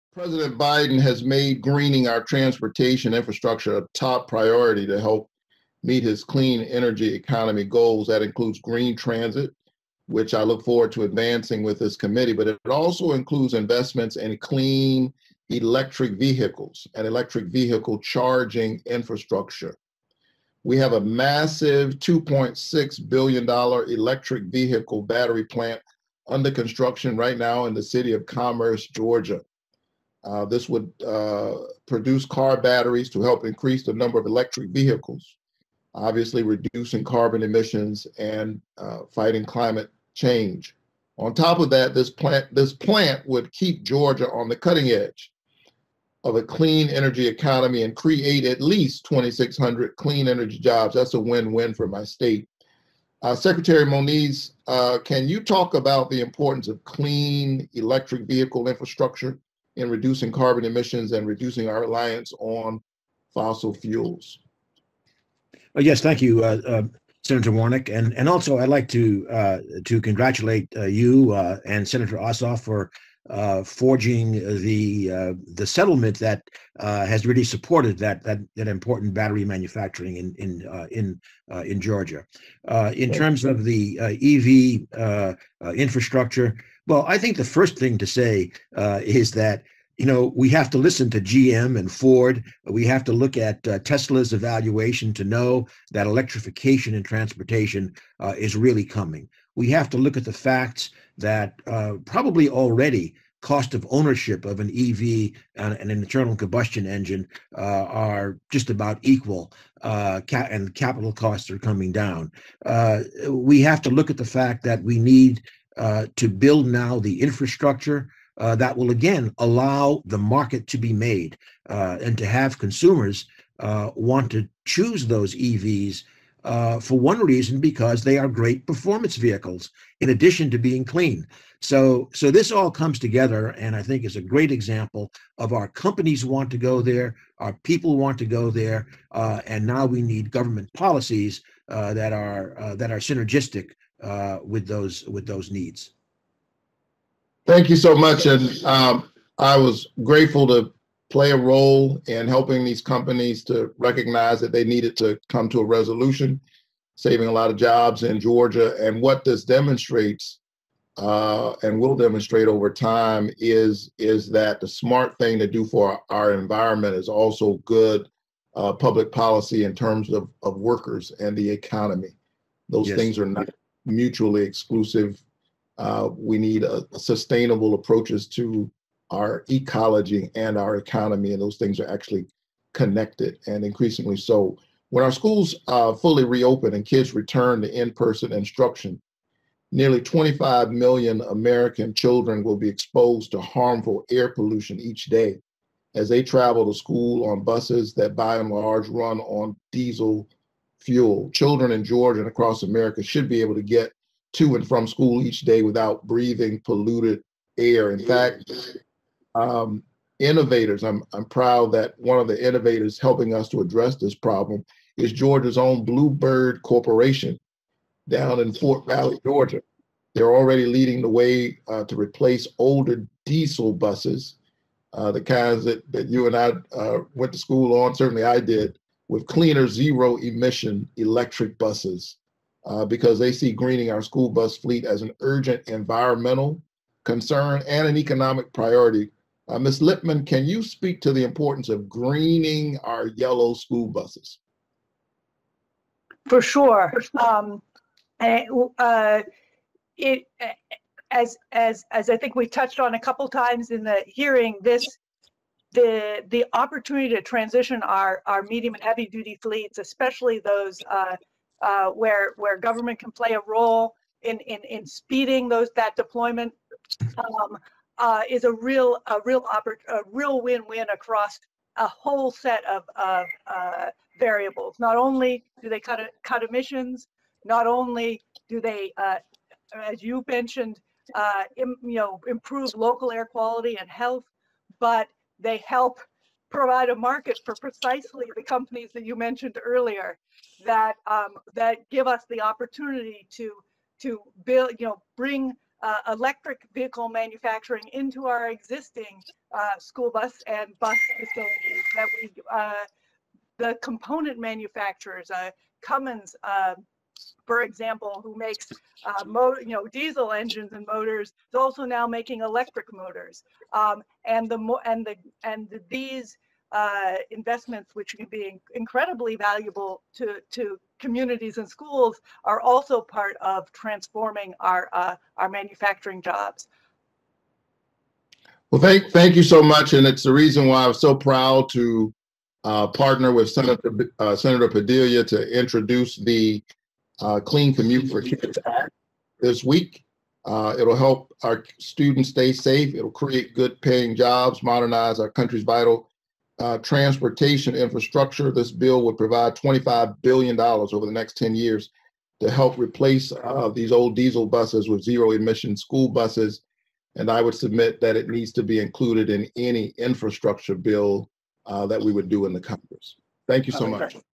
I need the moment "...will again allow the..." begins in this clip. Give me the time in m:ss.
1:58.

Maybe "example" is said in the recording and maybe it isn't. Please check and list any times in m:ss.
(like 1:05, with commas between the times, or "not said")
2:14, 5:07.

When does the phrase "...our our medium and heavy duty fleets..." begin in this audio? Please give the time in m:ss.
4:17.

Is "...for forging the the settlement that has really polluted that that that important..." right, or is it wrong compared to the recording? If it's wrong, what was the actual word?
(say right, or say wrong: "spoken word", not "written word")
wrong: "supported", not "polluted".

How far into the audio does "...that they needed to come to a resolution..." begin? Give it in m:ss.
2:34.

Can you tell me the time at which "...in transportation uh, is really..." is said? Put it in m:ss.
1:36.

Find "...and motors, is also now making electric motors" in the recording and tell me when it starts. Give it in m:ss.
5:10.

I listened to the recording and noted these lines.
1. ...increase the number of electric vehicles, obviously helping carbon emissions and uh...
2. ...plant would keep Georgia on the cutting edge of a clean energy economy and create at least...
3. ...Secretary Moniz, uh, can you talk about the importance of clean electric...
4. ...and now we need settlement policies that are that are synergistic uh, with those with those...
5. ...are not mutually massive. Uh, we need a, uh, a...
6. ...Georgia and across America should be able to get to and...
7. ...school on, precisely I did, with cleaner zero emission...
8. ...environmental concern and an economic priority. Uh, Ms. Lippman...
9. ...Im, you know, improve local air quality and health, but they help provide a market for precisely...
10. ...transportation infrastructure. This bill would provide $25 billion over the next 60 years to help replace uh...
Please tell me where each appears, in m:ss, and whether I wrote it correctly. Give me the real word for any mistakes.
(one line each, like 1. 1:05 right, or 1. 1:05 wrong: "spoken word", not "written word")
1. 0:33 wrong: "reducing", not "helping"
2. 0:42 right
3. 0:53 right
4. 2:19 wrong: "government", not "settlement"
5. 2:53 wrong: "exclusive", not "massive"
6. 3:21 right
7. 3:47 wrong: "certainly", not "precisely"
8. 3:55 right
9. 4:41 right
10. 5:46 wrong: "10", not "60".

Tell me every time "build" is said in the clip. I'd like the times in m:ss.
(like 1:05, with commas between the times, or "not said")
1:56, 4:54.